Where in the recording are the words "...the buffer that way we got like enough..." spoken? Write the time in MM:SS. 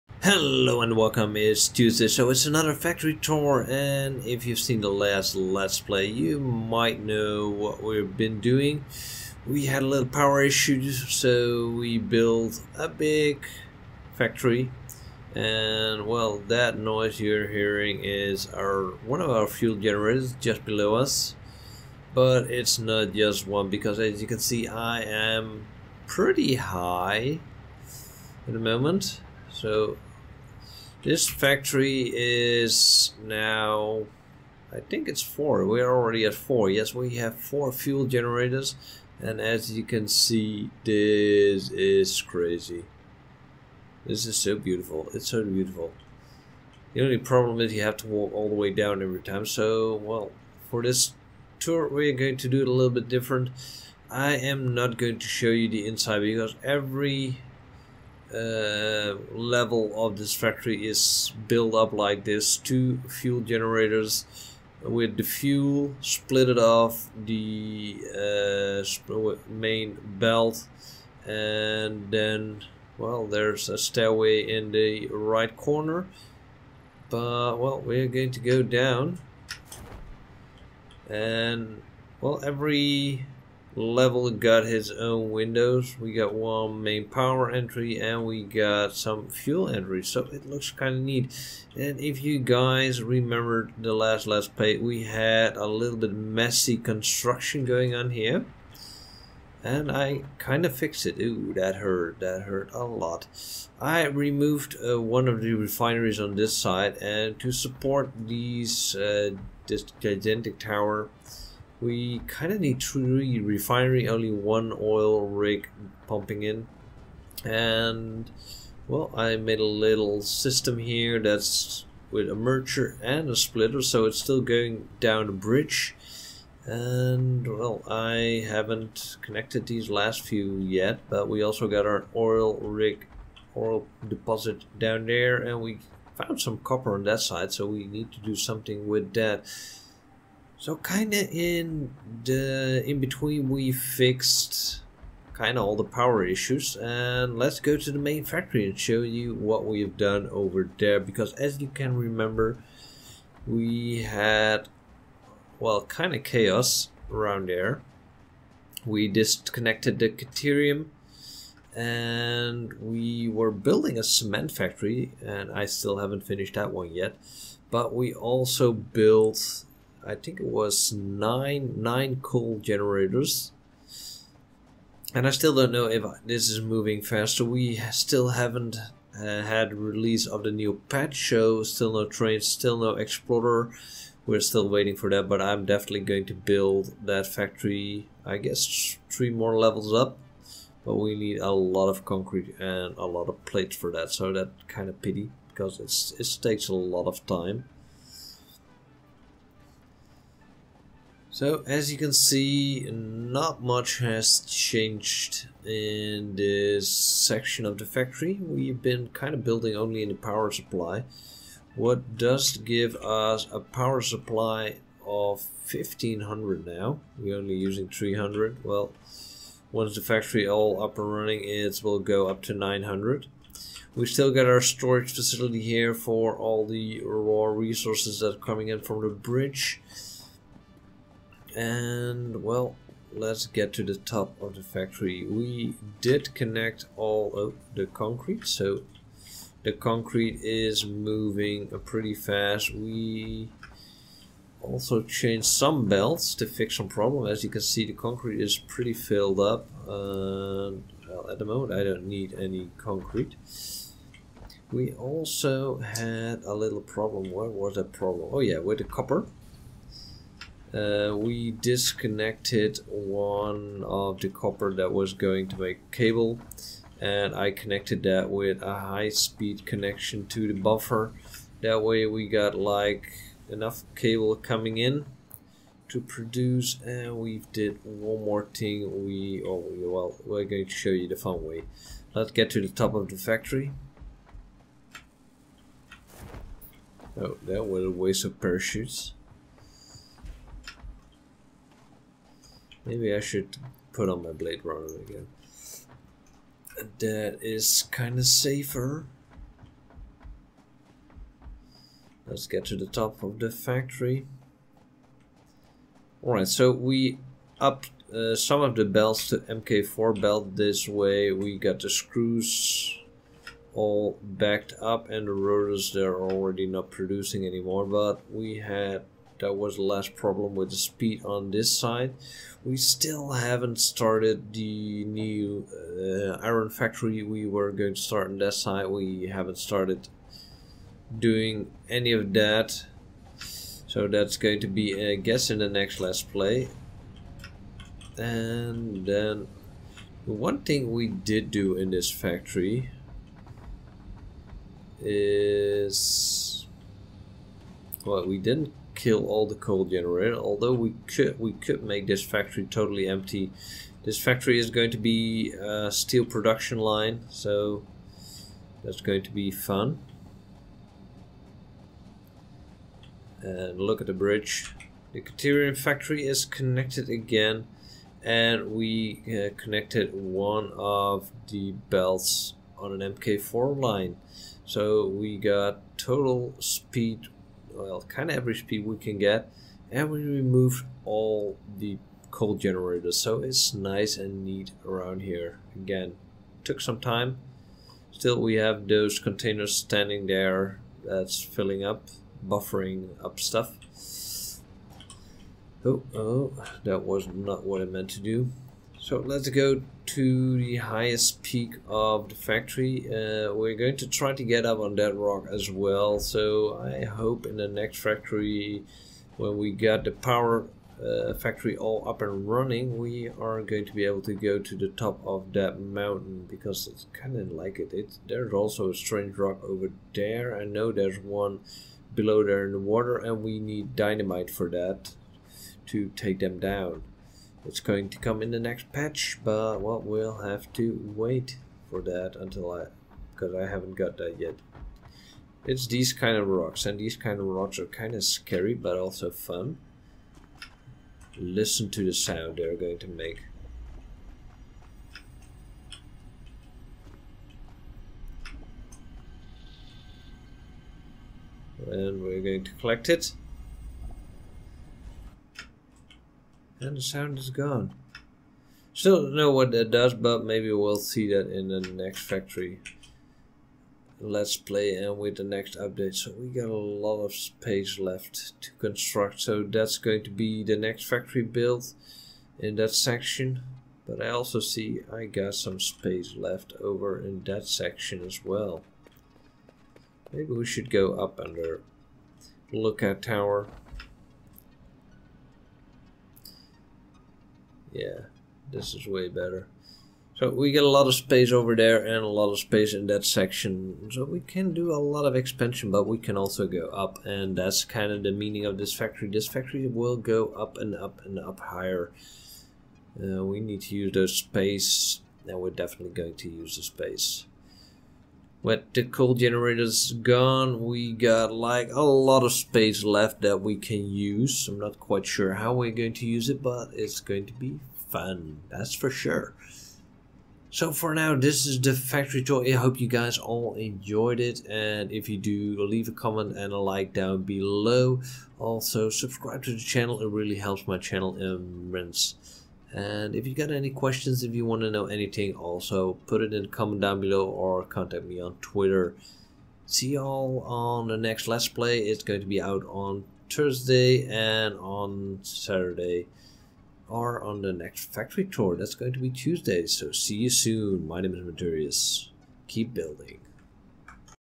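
04:30.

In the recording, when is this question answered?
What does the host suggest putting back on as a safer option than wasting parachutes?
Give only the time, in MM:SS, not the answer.
04:54.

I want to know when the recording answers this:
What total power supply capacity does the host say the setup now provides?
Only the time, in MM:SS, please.
03:35.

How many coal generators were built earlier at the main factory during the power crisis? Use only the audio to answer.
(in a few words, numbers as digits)
9.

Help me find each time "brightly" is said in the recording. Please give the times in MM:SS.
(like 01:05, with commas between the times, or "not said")
not said.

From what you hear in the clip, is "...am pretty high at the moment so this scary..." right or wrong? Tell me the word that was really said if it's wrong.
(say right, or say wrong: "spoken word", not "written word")
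wrong: "factory", not "scary".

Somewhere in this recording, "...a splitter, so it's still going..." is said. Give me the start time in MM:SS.
02:03.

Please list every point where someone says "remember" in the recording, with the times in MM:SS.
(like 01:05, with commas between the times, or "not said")
01:33, 02:31.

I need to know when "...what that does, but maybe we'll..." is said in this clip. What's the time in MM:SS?
07:39.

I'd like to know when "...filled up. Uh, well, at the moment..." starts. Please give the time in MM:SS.
04:08.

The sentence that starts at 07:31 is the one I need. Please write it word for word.
And we're going to collect it.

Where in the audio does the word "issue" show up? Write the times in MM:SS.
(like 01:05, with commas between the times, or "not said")
00:10, 02:26.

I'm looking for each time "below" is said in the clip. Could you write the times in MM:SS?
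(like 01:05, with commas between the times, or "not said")
00:20, 07:02, 08:47, 08:57.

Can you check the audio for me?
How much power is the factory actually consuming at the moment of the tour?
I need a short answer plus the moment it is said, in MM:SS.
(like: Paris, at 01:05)
300, at 03:37.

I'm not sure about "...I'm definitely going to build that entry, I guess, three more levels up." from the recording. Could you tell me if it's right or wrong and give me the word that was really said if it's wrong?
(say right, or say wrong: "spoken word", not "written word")
wrong: "factory", not "entry".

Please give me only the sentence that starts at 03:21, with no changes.
So as you can see, not much has changed in this section of the factory.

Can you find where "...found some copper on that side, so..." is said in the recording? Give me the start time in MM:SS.
02:16.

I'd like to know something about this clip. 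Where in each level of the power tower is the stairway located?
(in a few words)
Right corner.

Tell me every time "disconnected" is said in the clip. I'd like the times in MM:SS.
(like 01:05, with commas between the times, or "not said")
02:39, 04:21.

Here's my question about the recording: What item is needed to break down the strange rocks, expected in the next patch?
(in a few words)
Dynamite.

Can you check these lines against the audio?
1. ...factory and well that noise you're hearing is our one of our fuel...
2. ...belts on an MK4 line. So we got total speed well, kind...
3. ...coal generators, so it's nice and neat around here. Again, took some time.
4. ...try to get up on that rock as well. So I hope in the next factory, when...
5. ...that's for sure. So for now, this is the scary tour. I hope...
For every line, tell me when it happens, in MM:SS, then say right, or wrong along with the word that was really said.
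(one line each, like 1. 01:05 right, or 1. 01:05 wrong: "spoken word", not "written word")
1. 00:14 right
2. 06:11 right
3. 06:22 right
4. 06:44 right
5. 08:38 wrong: "factory", not "scary".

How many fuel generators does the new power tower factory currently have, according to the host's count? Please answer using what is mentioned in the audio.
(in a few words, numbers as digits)
4.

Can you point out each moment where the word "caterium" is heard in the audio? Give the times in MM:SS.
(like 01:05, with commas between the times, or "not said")
02:40, 06:05.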